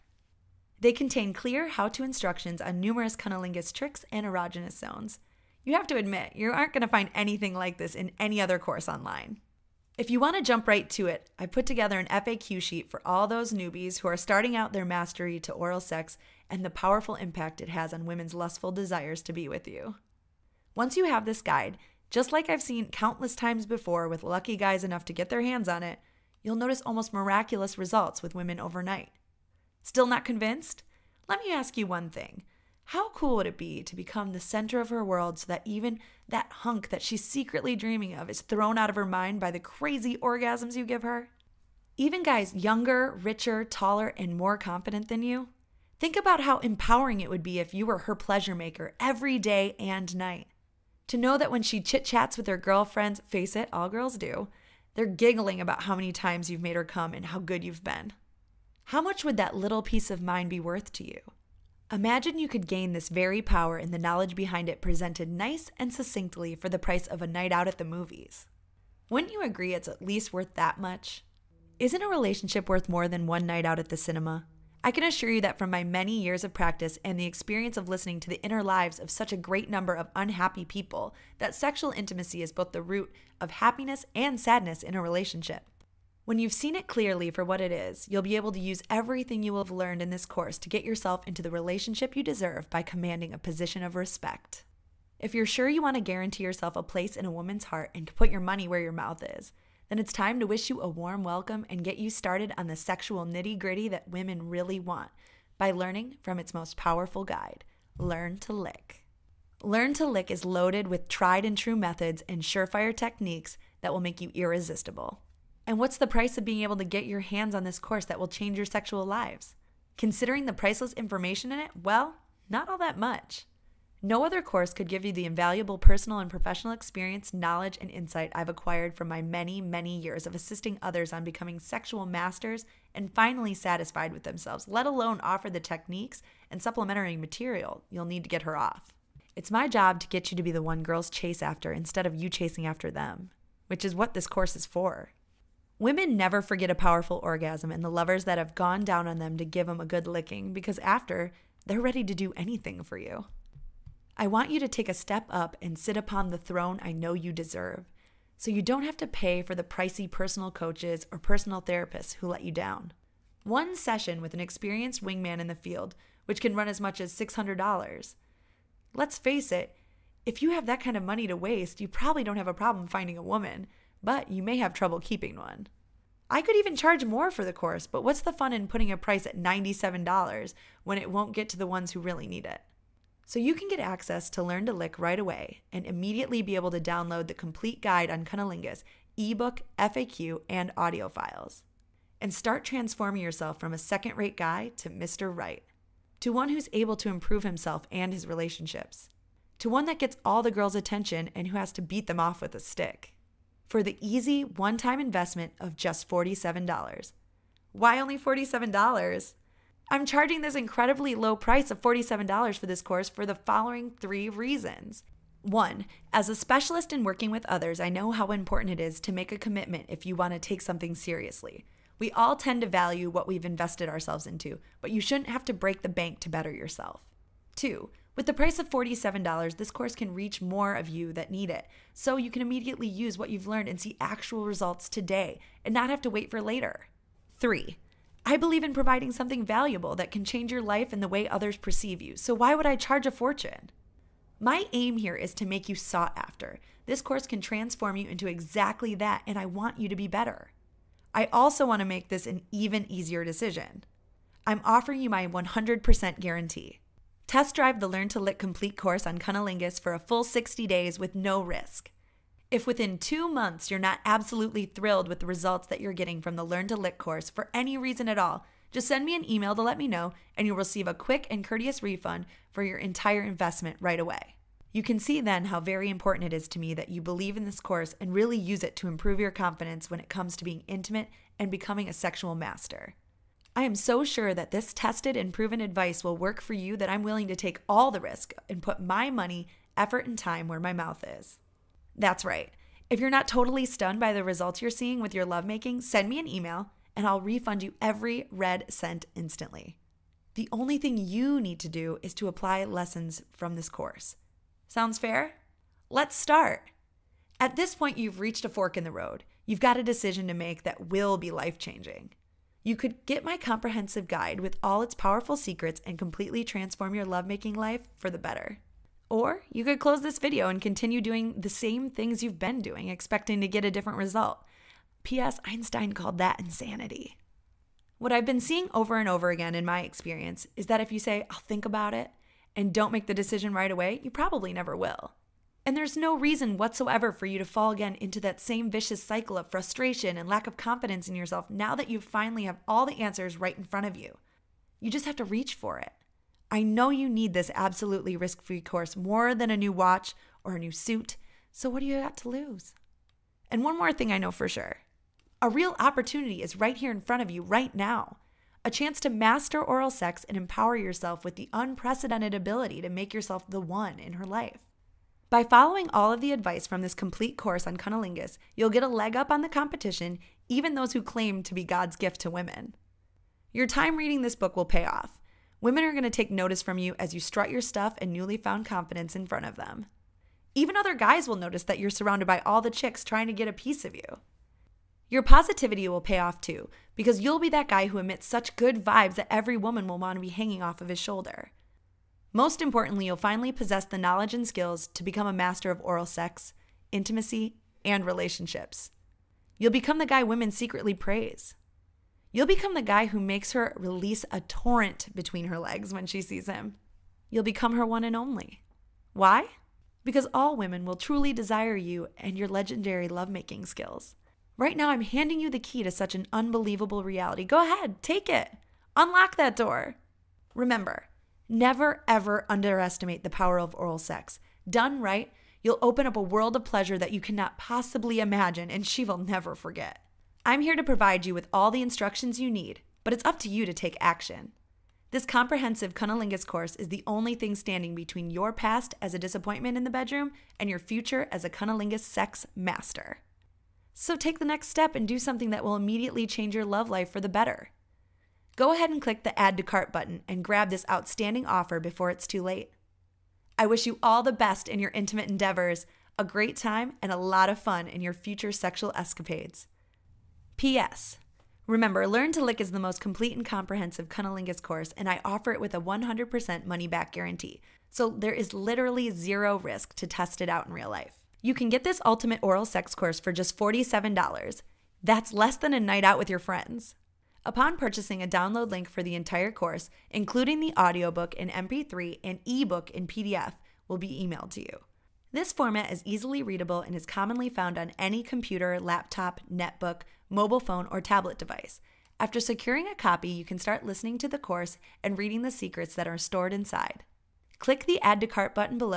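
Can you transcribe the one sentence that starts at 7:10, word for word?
I'm here to provide you with all the instructions you need, but it's up to you to take action.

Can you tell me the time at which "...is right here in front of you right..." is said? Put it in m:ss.
5:56.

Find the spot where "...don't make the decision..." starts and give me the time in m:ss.
5:32.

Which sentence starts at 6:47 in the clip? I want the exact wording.
You'll become her one and only.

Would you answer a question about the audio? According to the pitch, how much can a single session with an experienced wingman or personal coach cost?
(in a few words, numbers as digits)
$600.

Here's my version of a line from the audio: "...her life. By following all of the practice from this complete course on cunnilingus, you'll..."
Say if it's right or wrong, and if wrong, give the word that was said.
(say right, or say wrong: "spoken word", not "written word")
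wrong: "advice", not "practice".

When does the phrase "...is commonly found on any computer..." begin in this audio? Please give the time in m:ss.
8:06.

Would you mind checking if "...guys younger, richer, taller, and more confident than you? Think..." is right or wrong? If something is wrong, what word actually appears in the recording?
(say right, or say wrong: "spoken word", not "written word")
right.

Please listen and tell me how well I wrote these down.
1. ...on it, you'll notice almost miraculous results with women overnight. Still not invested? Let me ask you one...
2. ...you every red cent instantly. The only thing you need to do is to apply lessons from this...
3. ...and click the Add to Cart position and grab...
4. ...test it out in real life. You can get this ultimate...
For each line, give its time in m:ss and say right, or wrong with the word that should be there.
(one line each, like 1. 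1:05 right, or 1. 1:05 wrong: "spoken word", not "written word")
1. 0:25 wrong: "convinced", not "invested"
2. 4:57 right
3. 7:28 wrong: "button", not "position"
4. 7:50 right.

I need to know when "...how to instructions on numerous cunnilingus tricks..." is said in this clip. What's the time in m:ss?
0:01.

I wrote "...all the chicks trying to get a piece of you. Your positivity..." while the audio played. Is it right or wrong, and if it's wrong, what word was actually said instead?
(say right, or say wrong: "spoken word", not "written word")
right.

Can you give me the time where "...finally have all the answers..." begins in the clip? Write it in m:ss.
5:41.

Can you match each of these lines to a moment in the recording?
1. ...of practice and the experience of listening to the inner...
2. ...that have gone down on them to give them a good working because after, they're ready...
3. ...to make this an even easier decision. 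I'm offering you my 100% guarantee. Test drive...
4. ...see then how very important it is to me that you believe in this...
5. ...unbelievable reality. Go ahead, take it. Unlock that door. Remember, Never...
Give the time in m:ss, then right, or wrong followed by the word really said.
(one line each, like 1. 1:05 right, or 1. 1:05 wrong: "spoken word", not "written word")
1. 1:16 right
2. 2:28 wrong: "licking", not "working"
3. 4:11 right
4. 4:34 right
5. 6:56 right.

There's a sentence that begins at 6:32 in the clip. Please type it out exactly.
Most importantly, you'll finally possess the knowledge and skills to become a master of oral sex, intimacy, and relationships.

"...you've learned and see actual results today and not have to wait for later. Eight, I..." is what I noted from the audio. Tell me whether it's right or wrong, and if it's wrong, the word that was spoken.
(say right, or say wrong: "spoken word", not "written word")
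wrong: "Three", not "Eight".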